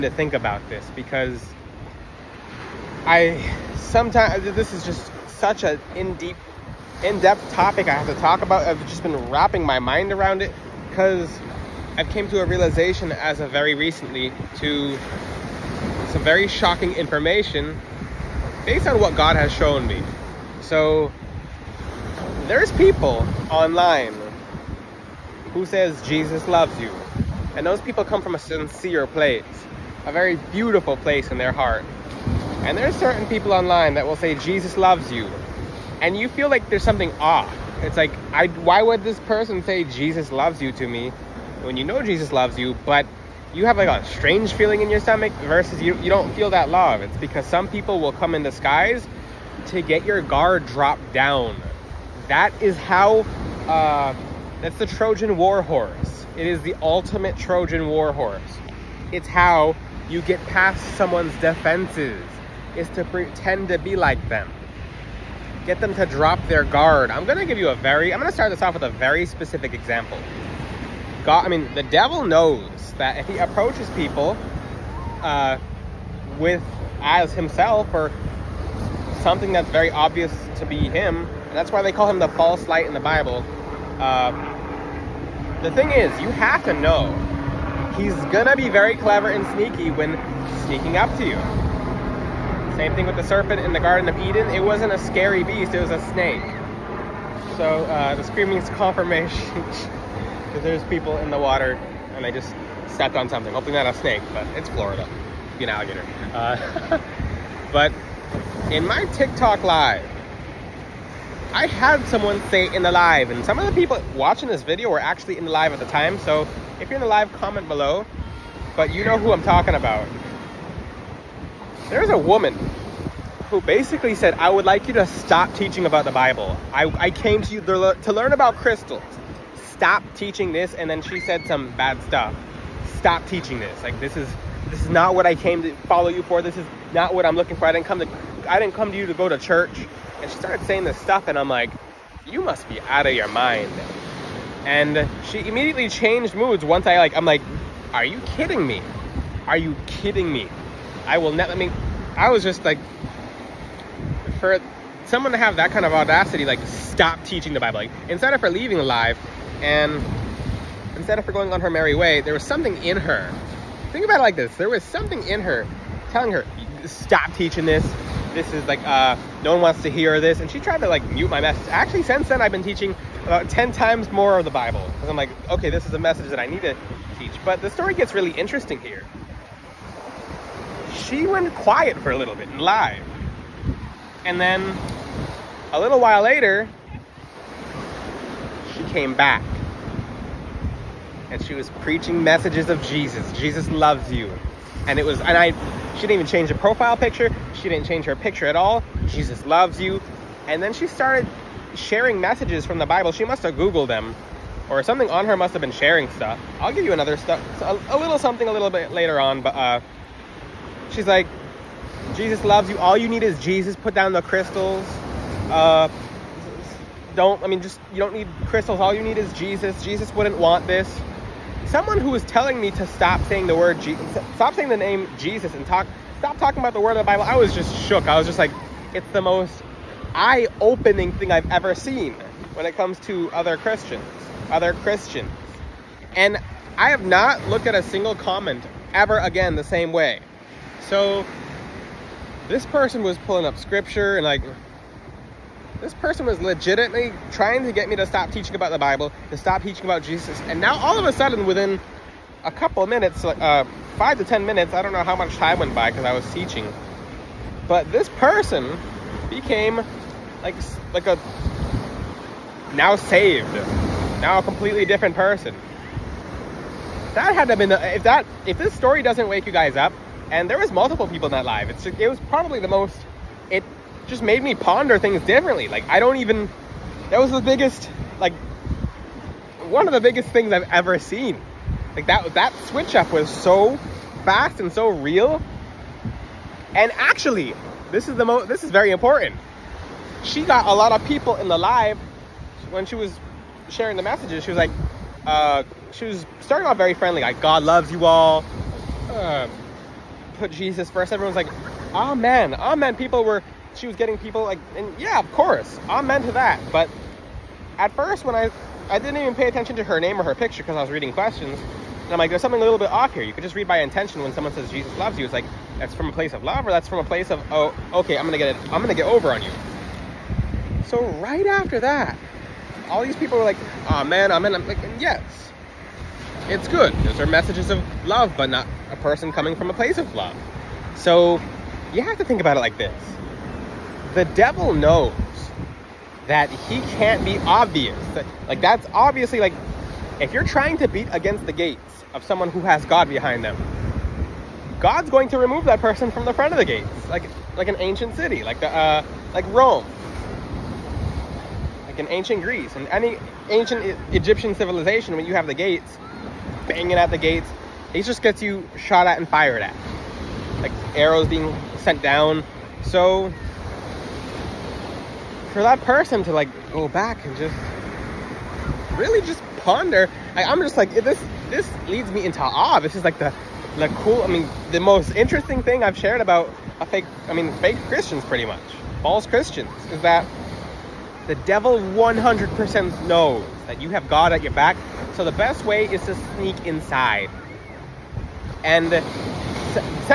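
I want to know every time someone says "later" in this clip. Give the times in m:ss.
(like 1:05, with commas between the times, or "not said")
3:06, 3:28.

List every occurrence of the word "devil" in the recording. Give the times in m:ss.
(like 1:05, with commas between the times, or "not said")
1:11, 5:34, 6:21.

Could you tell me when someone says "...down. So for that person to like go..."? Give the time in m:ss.
6:02.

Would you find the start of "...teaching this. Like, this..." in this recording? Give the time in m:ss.
2:13.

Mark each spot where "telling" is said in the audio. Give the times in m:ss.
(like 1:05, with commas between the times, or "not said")
2:46, 3:42.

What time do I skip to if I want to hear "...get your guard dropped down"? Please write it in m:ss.
0:49.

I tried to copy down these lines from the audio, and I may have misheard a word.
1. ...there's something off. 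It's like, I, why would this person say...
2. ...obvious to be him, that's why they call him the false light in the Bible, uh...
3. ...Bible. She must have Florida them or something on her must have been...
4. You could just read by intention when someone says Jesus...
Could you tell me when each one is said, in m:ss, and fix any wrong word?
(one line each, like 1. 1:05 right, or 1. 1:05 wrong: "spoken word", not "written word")
1. 0:36 right
2. 1:19 right
3. 3:22 wrong: "Googled", not "Florida"
4. 5:13 right.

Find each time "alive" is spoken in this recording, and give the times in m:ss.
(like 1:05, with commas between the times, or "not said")
2:38.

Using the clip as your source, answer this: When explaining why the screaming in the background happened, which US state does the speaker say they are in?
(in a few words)
Florida.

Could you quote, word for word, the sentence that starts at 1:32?
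Same thing with the serpent in the Garden of Eden.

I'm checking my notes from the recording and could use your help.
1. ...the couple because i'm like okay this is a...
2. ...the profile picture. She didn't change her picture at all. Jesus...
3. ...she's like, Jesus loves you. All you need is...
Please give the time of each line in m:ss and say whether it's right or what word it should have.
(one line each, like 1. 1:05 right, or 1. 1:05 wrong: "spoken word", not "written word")
1. 2:54 wrong: "bible", not "couple"
2. 3:16 right
3. 3:30 right.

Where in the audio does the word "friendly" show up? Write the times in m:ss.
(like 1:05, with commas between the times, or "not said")
4:56.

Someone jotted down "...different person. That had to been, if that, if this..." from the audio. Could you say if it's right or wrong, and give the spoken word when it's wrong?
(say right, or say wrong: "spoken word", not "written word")
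right.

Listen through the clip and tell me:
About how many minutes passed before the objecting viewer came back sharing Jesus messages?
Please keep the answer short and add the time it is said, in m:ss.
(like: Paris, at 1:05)
5 to 10 minutes, at 4:13.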